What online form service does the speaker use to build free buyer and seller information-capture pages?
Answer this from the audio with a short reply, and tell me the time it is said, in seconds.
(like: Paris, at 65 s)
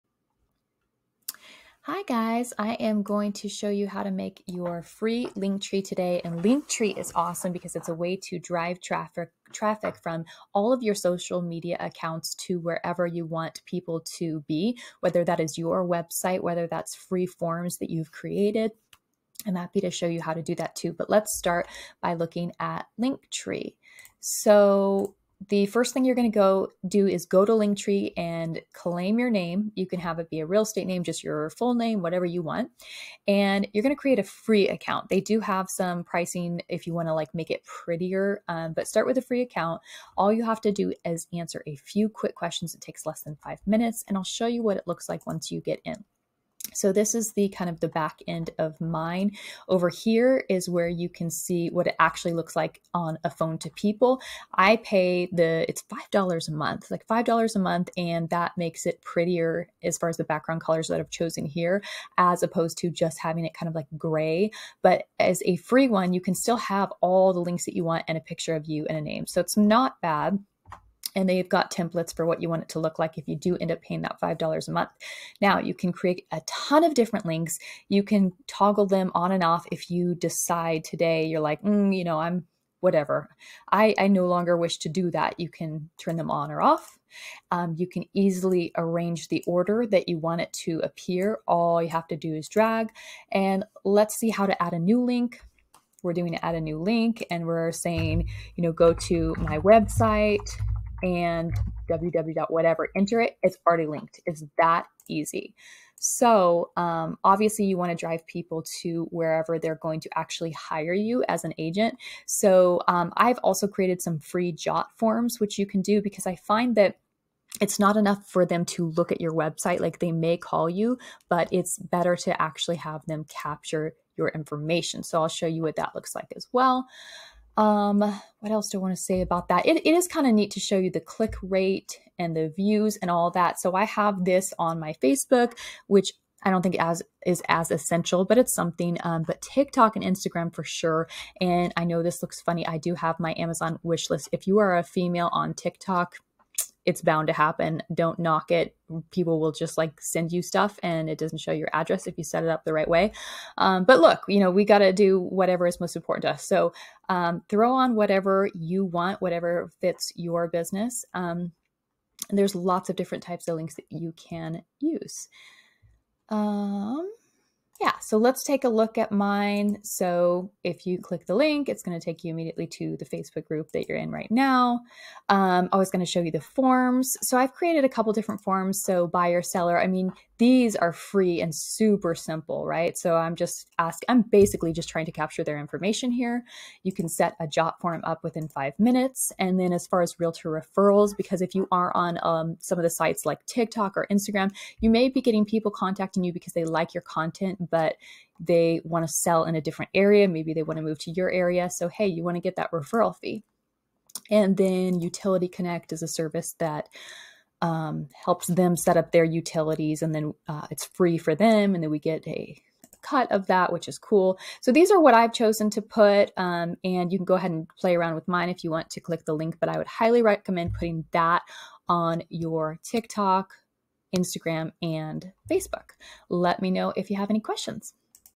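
Jot Form, at 114 s.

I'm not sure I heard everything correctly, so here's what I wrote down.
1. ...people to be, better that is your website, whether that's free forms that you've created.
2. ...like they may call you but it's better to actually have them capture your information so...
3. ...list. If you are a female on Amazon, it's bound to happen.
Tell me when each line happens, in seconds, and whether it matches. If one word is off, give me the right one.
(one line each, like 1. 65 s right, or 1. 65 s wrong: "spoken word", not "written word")
1. 13 s wrong: "whether", not "better"
2. 119 s right
3. 144 s wrong: "TikTok", not "Amazon".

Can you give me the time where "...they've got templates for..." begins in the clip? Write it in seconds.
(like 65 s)
71 s.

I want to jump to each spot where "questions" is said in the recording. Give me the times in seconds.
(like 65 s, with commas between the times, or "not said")
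42 s, 227 s.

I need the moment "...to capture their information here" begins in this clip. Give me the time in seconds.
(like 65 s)
185 s.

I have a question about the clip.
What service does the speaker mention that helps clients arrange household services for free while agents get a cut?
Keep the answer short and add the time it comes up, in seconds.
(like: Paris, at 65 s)
Utility Connect, at 204 s.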